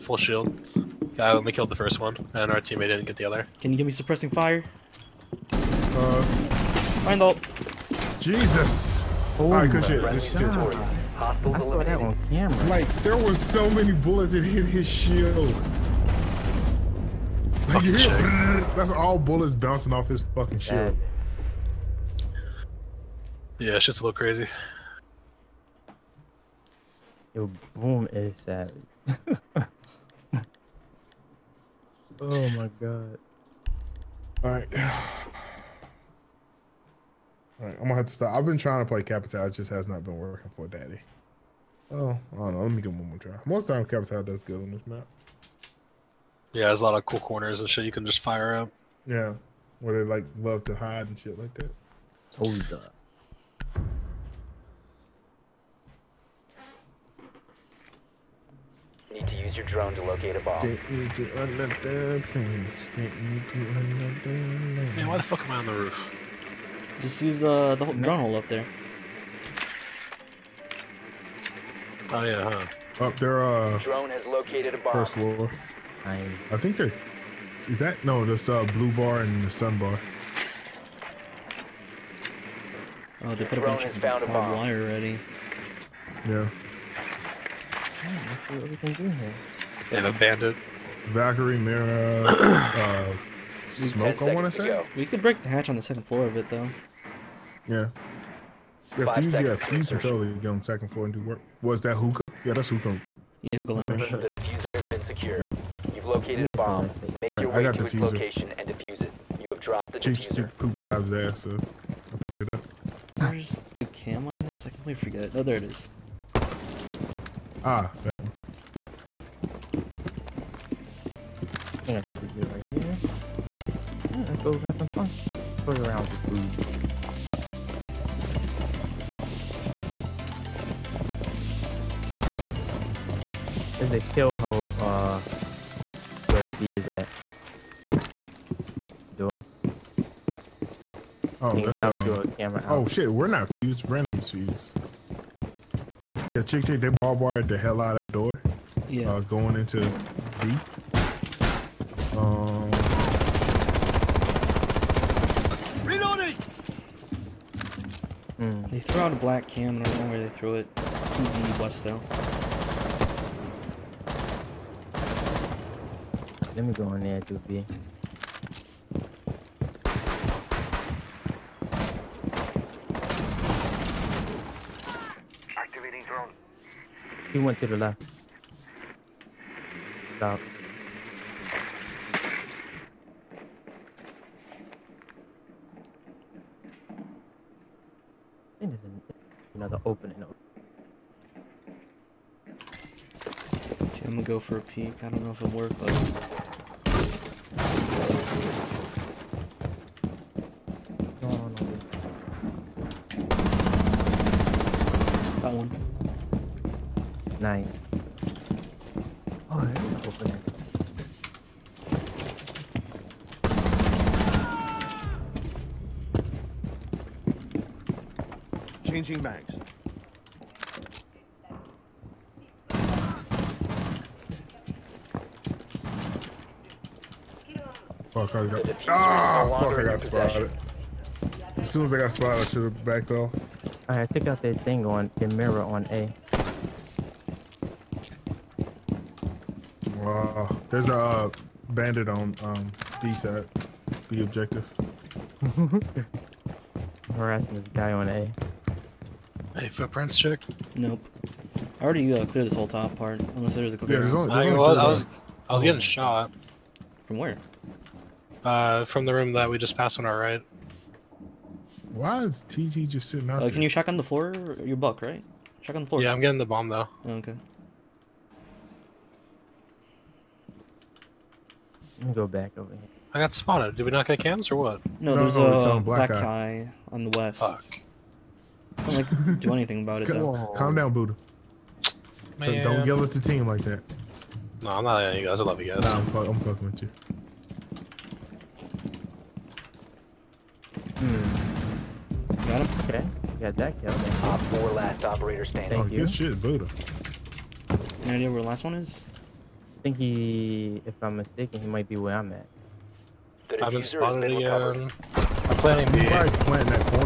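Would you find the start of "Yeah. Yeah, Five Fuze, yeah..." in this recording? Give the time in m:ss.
1:37.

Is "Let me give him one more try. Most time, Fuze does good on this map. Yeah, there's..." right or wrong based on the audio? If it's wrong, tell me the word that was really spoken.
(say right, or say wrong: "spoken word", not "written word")
wrong: "Capitão", not "Fuze".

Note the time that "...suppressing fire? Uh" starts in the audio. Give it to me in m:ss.
0:03.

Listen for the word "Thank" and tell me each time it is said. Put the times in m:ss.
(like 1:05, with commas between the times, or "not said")
4:55.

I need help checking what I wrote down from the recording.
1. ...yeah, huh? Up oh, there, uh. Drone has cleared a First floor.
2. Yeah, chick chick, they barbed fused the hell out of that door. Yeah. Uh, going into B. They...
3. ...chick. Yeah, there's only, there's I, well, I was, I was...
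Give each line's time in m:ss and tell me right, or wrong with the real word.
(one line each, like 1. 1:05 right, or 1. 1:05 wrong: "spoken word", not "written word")
1. 1:12 wrong: "located", not "cleared"
2. 2:26 wrong: "wired", not "fused"
3. 4:13 wrong: "quick", not "chick".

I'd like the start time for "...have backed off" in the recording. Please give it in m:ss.
3:52.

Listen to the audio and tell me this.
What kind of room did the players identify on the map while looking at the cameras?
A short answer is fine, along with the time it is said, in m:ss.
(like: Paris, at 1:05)
Hookah lounge, at 1:43.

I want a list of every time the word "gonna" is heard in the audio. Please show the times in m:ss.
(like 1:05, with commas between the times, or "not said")
0:37, 3:14.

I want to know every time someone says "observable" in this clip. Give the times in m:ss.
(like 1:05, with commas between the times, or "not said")
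not said.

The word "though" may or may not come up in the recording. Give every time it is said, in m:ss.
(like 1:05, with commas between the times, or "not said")
1:36, 2:41, 4:26, 4:40.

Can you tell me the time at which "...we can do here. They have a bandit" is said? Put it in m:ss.
1:28.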